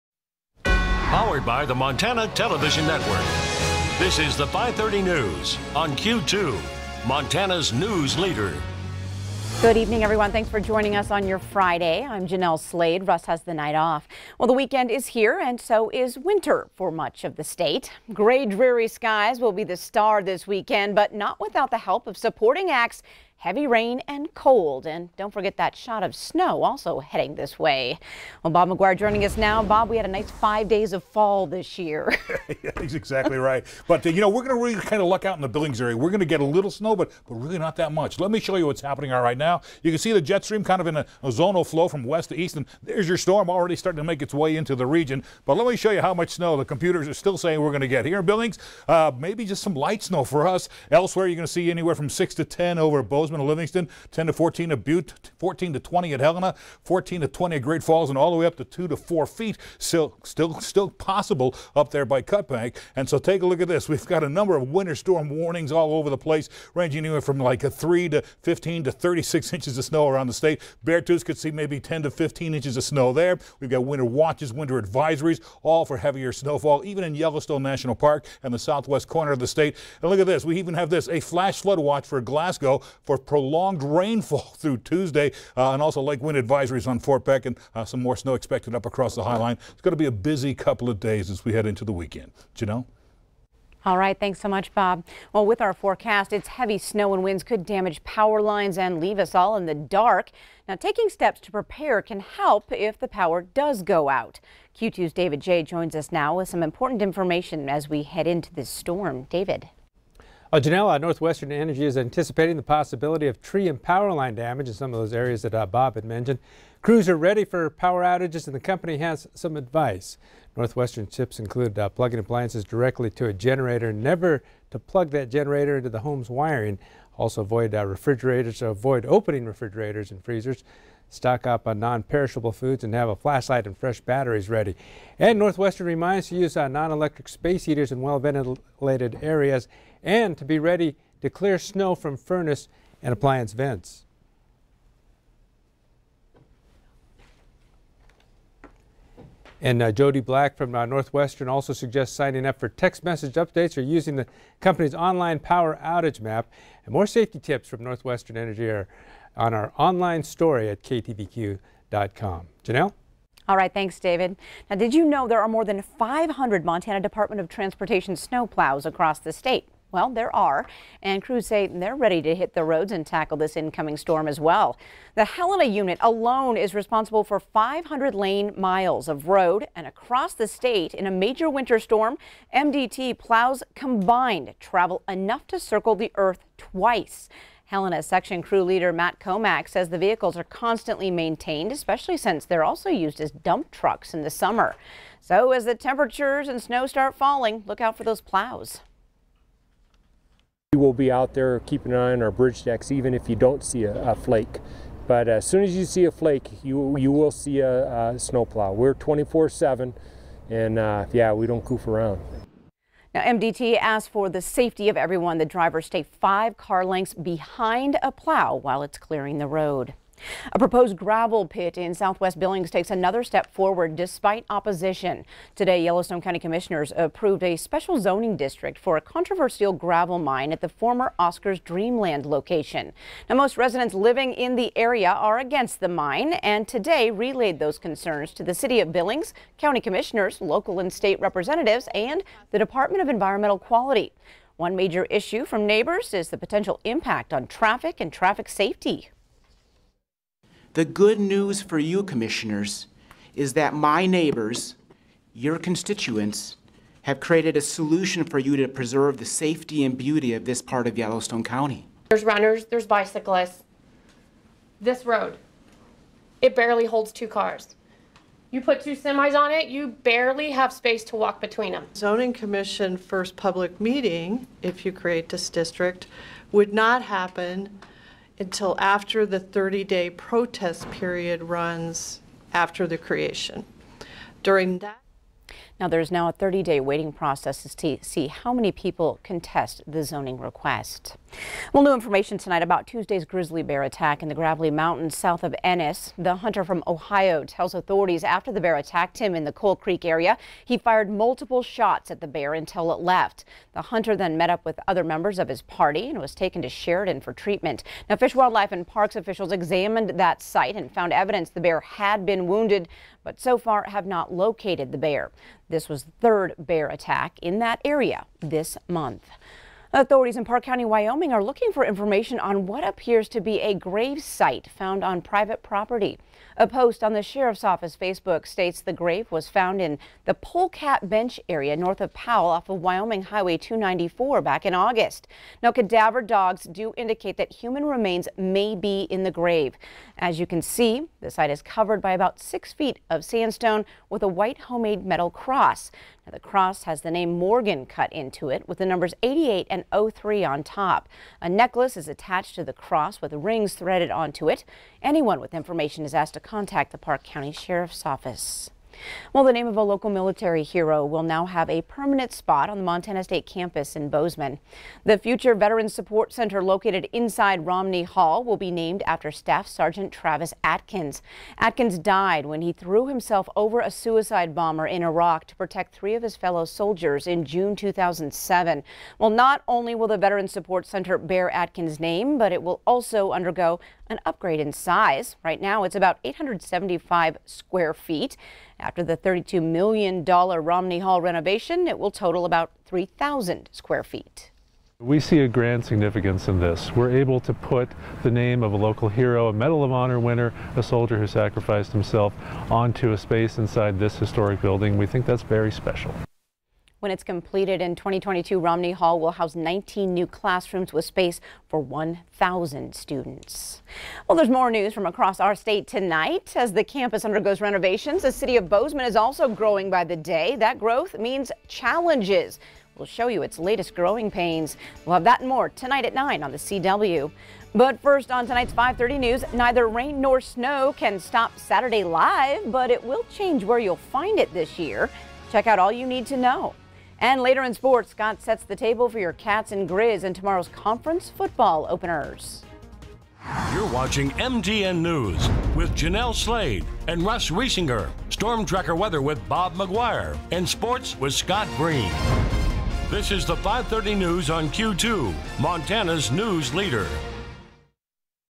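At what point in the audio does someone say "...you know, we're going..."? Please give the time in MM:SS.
00:34.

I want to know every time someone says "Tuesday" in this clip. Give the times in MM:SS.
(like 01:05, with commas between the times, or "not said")
01:24, 04:52.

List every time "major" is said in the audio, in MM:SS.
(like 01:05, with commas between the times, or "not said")
03:01, 04:04.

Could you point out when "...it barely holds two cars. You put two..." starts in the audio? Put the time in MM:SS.
04:26.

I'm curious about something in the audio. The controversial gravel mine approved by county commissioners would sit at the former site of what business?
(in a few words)
Oscars Dreamland.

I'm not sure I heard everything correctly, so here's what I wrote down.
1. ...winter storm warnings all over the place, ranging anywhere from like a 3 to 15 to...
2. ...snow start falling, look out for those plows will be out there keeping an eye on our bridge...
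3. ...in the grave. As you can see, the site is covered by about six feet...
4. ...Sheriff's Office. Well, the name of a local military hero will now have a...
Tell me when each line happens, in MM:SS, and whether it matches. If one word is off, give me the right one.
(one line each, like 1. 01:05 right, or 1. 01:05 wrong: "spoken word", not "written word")
1. 01:04 right
2. 03:16 right
3. 05:39 right
4. 05:57 right.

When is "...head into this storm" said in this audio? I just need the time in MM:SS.
01:48.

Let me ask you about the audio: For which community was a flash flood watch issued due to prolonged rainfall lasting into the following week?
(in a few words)
Glasgow.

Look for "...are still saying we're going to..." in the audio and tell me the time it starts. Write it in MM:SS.
00:47.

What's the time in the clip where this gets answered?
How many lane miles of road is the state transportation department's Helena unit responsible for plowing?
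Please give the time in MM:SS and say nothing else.
02:57.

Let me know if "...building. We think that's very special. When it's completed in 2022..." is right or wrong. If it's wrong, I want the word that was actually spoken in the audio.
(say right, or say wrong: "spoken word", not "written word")
right.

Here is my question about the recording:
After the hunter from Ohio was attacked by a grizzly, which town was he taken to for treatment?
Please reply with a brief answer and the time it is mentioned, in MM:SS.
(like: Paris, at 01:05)
Sheridan, at 05:06.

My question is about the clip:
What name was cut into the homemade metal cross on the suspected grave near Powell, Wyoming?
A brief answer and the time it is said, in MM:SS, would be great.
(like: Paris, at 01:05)
Morgan, at 05:47.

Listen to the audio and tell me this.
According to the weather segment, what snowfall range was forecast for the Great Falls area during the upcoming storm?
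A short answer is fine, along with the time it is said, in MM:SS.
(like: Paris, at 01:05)
14 to 20, at 00:56.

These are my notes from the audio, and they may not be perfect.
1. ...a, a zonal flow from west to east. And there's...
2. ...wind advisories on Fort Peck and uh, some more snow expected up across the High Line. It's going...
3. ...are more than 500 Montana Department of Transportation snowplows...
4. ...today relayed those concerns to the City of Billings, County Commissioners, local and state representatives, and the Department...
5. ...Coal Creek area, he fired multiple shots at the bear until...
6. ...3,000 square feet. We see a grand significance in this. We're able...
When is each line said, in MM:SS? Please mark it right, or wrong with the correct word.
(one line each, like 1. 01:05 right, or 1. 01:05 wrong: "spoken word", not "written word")
1. 00:40 right
2. 01:26 right
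3. 02:45 right
4. 03:56 right
5. 04:59 right
6. 06:32 right.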